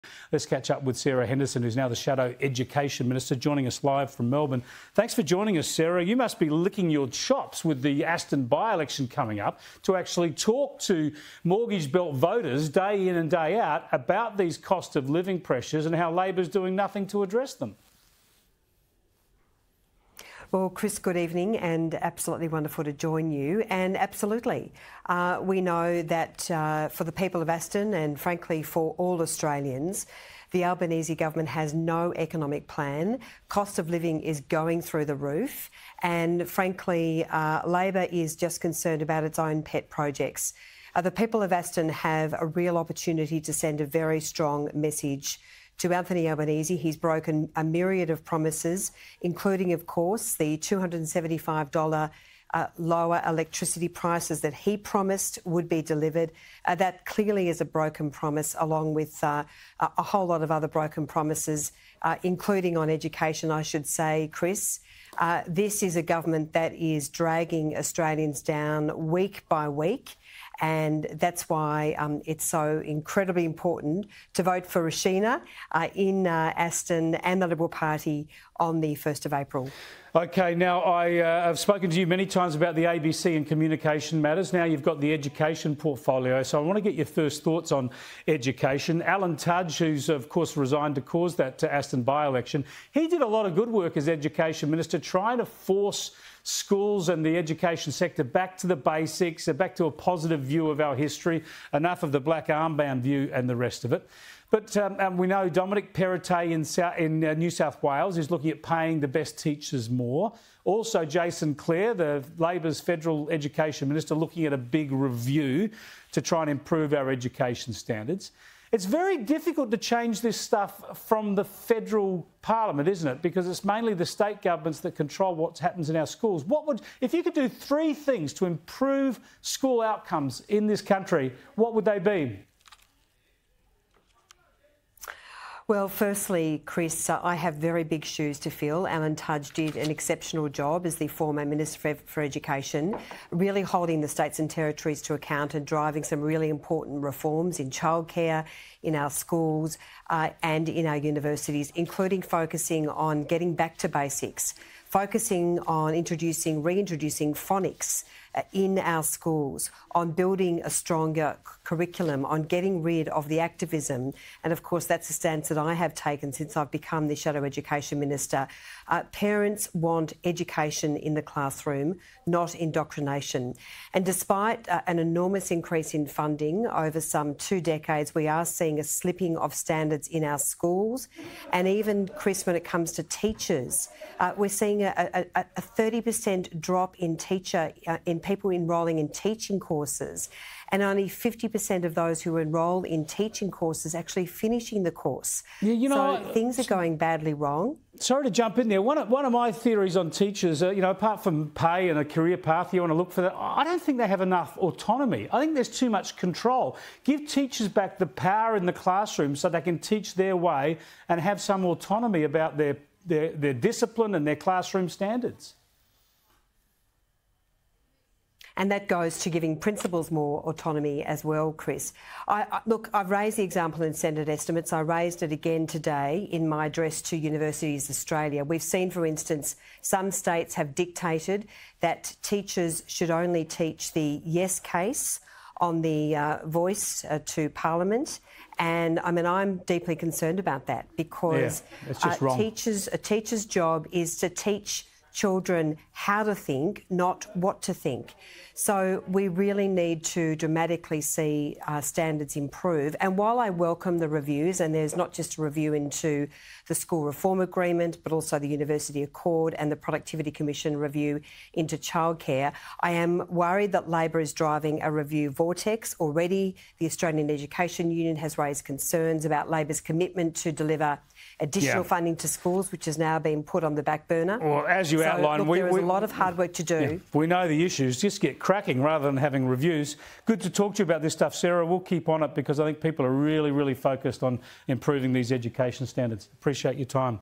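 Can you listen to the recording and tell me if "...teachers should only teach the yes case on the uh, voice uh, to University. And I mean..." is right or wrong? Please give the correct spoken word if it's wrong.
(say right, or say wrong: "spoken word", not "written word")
wrong: "Parliament", not "University".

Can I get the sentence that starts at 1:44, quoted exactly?
But um, um we know Dominic Perrottet in, South, in uh, New South Wales is looking at paying the best teachers more.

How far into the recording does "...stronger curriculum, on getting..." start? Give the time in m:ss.
2:40.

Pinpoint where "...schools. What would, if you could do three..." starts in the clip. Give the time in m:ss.
2:06.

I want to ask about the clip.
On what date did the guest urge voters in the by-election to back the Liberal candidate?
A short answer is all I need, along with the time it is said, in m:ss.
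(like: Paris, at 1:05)
1st of April, at 1:18.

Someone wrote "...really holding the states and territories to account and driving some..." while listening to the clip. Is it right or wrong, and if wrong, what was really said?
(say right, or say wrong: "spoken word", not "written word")
right.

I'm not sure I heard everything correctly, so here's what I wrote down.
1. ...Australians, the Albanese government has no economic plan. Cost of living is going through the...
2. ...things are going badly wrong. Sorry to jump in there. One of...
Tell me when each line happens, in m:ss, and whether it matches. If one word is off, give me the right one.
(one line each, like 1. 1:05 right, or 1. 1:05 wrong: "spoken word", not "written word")
1. 0:29 right
2. 3:16 right.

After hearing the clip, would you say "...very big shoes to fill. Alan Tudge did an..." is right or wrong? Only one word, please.
right.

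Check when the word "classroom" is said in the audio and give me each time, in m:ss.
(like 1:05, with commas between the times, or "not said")
2:51, 3:28, 3:34.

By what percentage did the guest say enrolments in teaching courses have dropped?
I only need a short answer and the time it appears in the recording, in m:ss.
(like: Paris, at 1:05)
30%, at 3:05.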